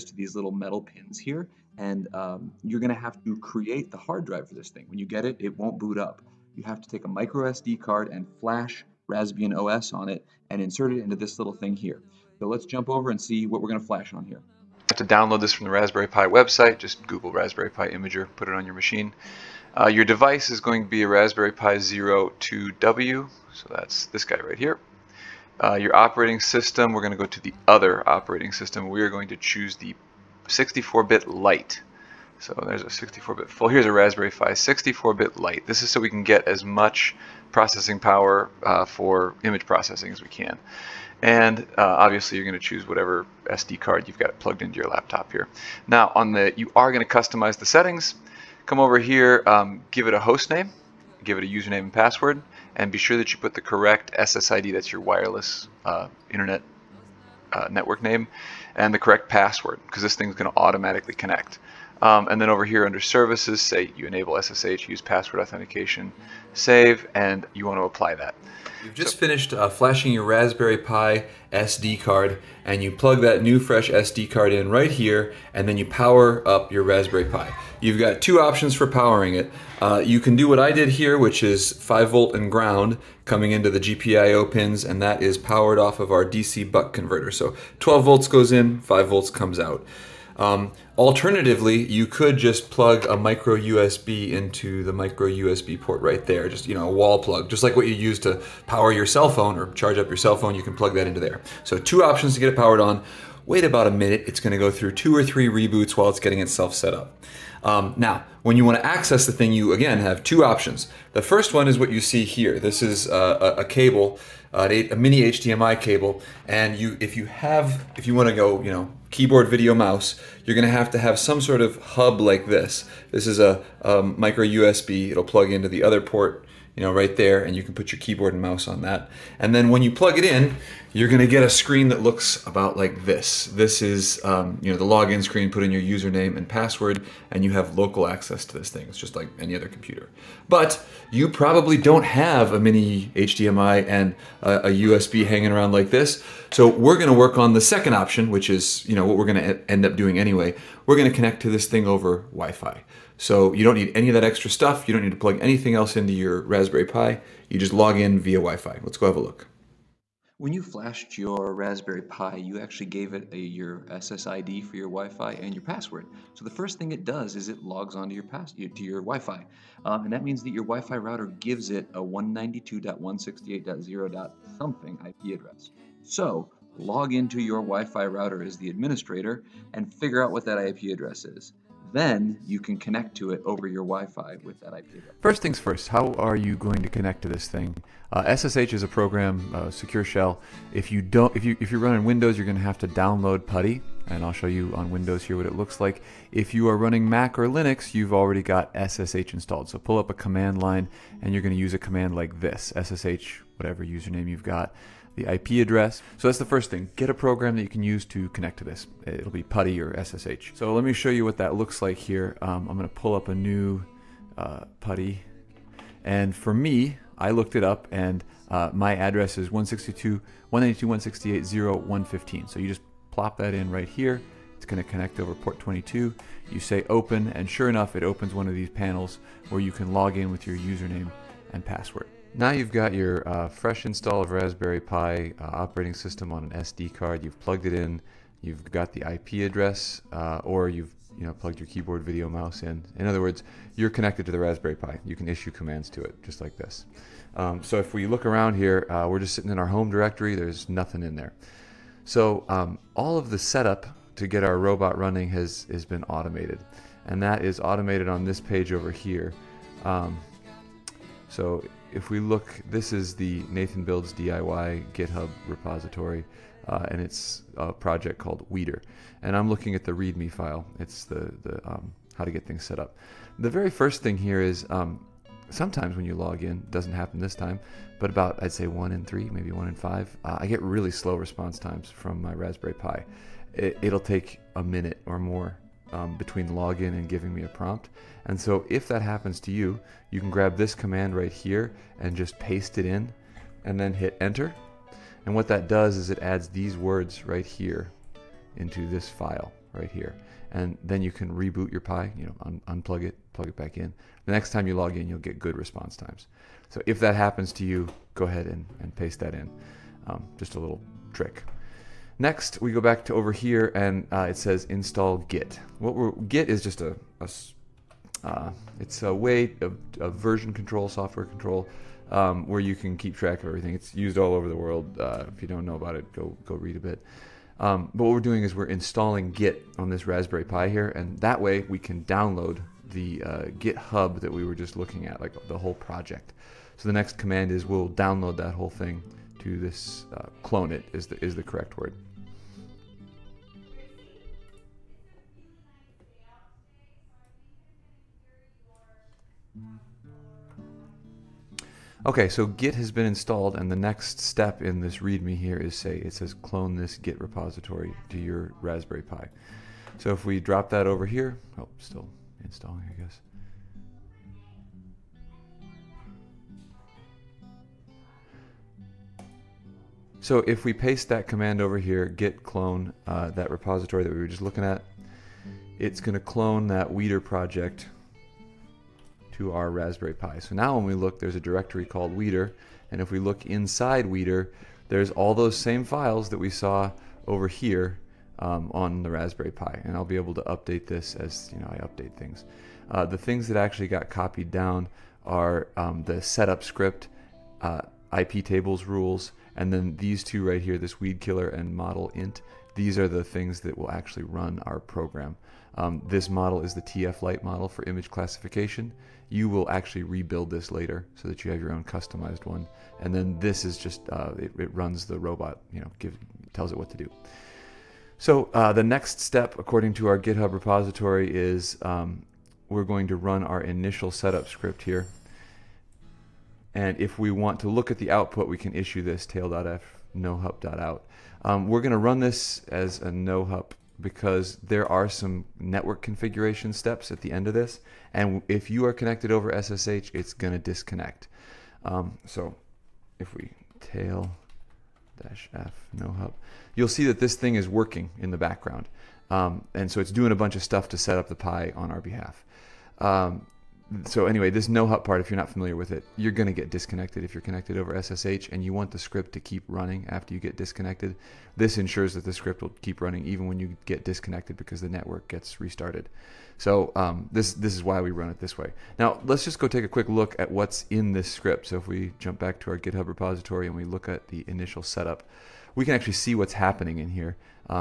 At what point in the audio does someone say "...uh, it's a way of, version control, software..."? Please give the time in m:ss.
5:18.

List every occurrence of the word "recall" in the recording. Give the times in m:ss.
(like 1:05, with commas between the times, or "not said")
not said.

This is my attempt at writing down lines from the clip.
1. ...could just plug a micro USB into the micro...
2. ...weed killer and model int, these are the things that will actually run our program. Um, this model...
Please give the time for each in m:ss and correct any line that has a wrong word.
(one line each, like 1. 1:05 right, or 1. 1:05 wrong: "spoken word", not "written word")
1. 1:32 right
2. 6:40 right.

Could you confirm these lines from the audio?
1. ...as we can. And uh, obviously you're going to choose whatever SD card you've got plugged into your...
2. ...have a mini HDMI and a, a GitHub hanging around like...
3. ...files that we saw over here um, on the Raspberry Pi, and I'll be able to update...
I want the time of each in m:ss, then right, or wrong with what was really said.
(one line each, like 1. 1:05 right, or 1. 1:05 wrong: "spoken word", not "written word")
1. 0:40 right
2. 2:22 wrong: "USB", not "GitHub"
3. 6:25 right.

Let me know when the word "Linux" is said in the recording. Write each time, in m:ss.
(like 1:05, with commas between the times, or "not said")
3:17.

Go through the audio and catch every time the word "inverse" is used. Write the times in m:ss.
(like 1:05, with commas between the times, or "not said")
not said.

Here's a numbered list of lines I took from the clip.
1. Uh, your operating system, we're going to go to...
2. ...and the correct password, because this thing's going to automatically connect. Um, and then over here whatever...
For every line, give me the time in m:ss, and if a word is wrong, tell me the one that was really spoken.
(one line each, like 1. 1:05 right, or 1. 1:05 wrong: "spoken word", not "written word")
1. 0:25 right
2. 0:58 wrong: "under", not "whatever".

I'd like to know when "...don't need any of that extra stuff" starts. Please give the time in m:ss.
2:33.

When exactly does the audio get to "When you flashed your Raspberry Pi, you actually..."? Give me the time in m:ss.
2:40.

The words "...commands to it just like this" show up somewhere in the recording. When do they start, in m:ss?
4:05.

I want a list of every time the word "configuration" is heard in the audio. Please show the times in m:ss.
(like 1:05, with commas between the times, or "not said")
7:16.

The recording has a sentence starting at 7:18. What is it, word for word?
And if you are connected over SSH, it's going to disconnect.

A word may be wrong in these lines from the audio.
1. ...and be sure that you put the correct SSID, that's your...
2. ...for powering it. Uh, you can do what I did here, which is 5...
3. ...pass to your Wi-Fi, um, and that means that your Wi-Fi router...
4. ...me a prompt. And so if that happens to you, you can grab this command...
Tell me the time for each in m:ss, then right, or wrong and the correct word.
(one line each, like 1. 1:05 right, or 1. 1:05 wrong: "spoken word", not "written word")
1. 0:52 right
2. 1:18 right
3. 2:48 right
4. 4:47 right.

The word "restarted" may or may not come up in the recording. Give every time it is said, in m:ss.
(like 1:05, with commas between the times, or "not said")
7:45.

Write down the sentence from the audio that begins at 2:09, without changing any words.
And then when you plug it in, you're gonna get a screen that looks about like this.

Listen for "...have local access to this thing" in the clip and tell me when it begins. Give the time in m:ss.
2:17.